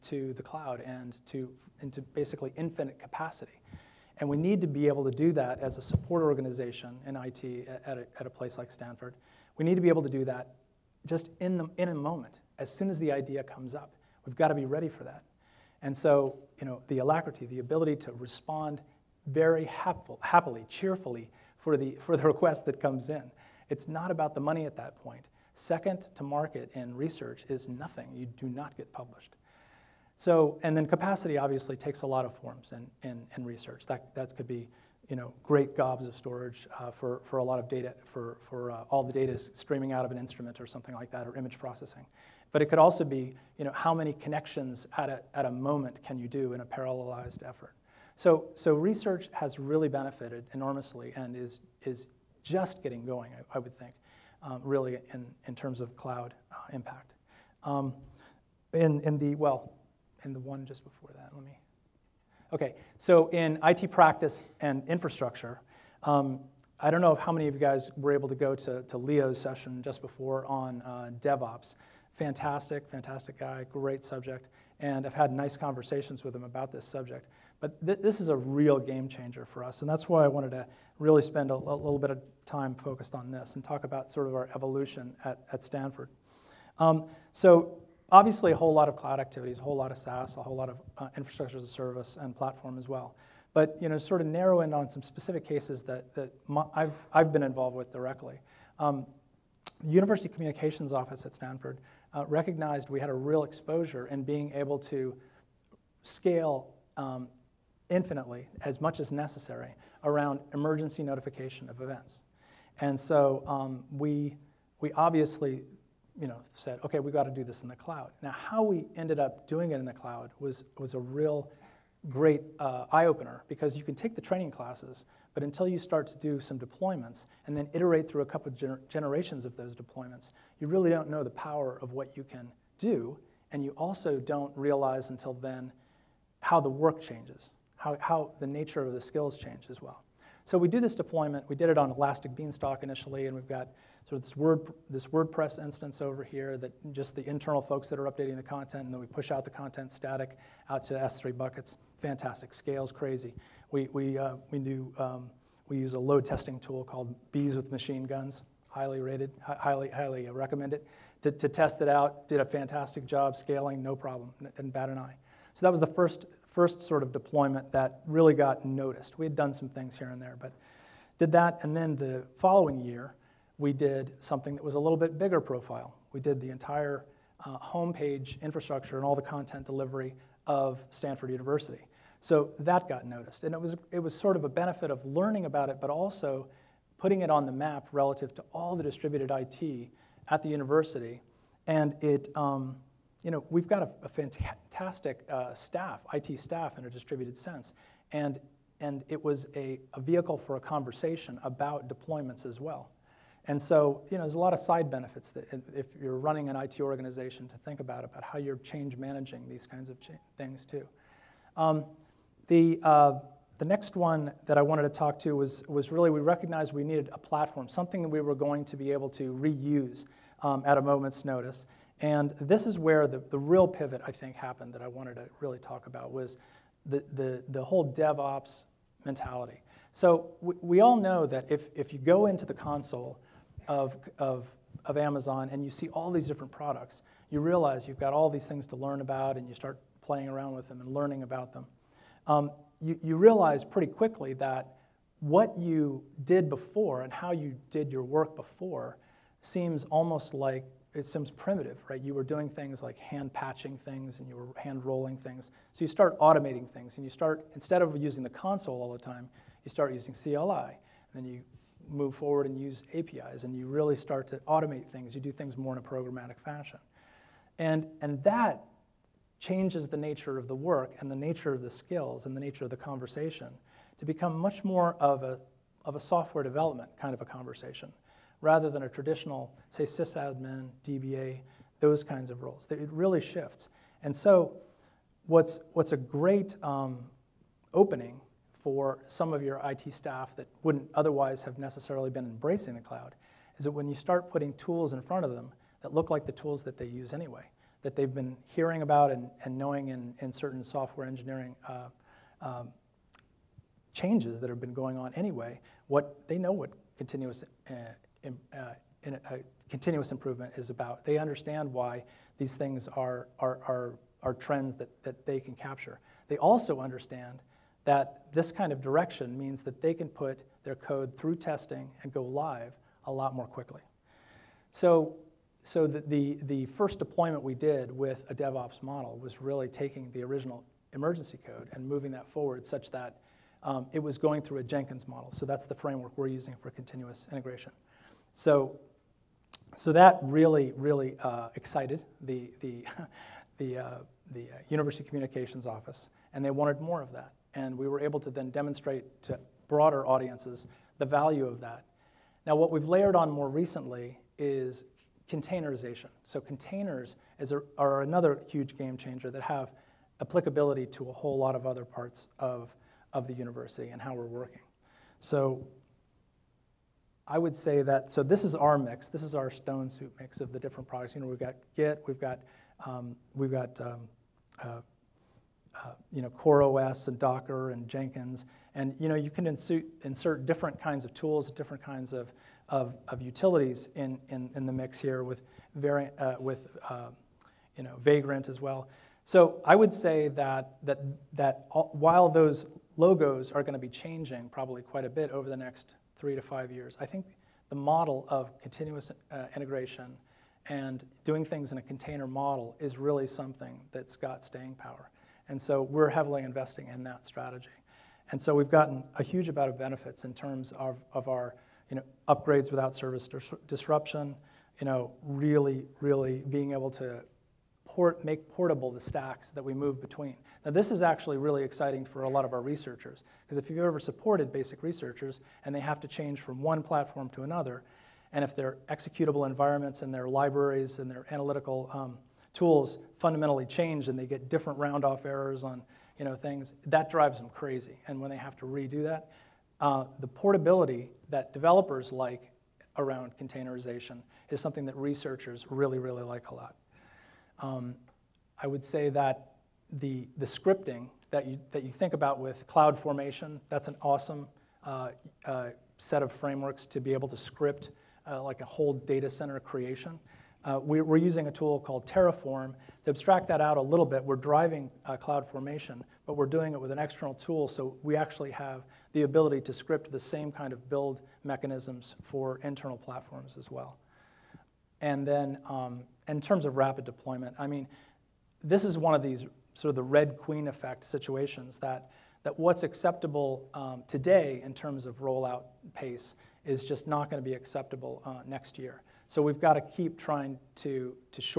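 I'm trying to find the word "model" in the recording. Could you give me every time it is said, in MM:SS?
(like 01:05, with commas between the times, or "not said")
05:28, 05:35, 06:37, 06:42.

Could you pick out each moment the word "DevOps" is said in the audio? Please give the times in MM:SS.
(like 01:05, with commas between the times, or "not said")
01:11, 03:47, 05:28.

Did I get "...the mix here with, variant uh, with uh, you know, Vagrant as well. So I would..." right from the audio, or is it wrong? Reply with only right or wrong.
right.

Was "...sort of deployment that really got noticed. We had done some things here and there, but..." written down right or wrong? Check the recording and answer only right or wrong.
right.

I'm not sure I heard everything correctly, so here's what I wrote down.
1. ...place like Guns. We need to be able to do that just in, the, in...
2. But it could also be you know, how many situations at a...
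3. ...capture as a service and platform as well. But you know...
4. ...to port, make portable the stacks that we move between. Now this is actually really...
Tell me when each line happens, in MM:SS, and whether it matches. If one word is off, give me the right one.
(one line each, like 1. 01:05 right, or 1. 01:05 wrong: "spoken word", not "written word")
1. 00:08 wrong: "Stanford", not "Guns"
2. 00:42 wrong: "connections", not "situations"
3. 01:31 wrong: "infrastructure", not "capture"
4. 06:56 right.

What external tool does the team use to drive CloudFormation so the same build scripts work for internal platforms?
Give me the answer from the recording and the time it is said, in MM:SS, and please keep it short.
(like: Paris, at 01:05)
Terraform, at 07:42.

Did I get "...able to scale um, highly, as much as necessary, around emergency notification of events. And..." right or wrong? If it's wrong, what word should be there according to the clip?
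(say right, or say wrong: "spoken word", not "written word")
wrong: "infinitely", not "highly".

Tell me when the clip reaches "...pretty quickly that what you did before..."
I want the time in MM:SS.
04:03.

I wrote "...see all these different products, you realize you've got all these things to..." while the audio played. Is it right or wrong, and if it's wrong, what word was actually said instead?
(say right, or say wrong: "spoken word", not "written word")
right.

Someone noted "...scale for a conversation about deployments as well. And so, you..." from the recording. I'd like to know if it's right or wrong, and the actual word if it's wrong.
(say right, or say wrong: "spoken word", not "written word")
wrong: "vehicle", not "scale".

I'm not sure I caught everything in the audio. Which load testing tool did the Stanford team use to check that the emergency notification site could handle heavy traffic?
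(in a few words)
Bees with Machine Guns.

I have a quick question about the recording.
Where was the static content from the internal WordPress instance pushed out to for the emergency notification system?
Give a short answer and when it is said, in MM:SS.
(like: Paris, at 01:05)
S3 buckets, at 02:30.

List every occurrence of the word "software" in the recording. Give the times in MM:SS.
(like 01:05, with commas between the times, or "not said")
04:35, 05:00.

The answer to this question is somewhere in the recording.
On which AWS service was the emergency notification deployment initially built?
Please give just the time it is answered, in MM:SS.
02:21.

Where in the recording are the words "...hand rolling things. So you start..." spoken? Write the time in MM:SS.
04:14.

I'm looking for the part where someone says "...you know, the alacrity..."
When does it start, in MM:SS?
00:16.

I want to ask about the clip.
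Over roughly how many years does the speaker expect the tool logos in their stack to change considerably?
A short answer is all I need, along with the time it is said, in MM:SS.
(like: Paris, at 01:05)
3 to 5 years, at 06:36.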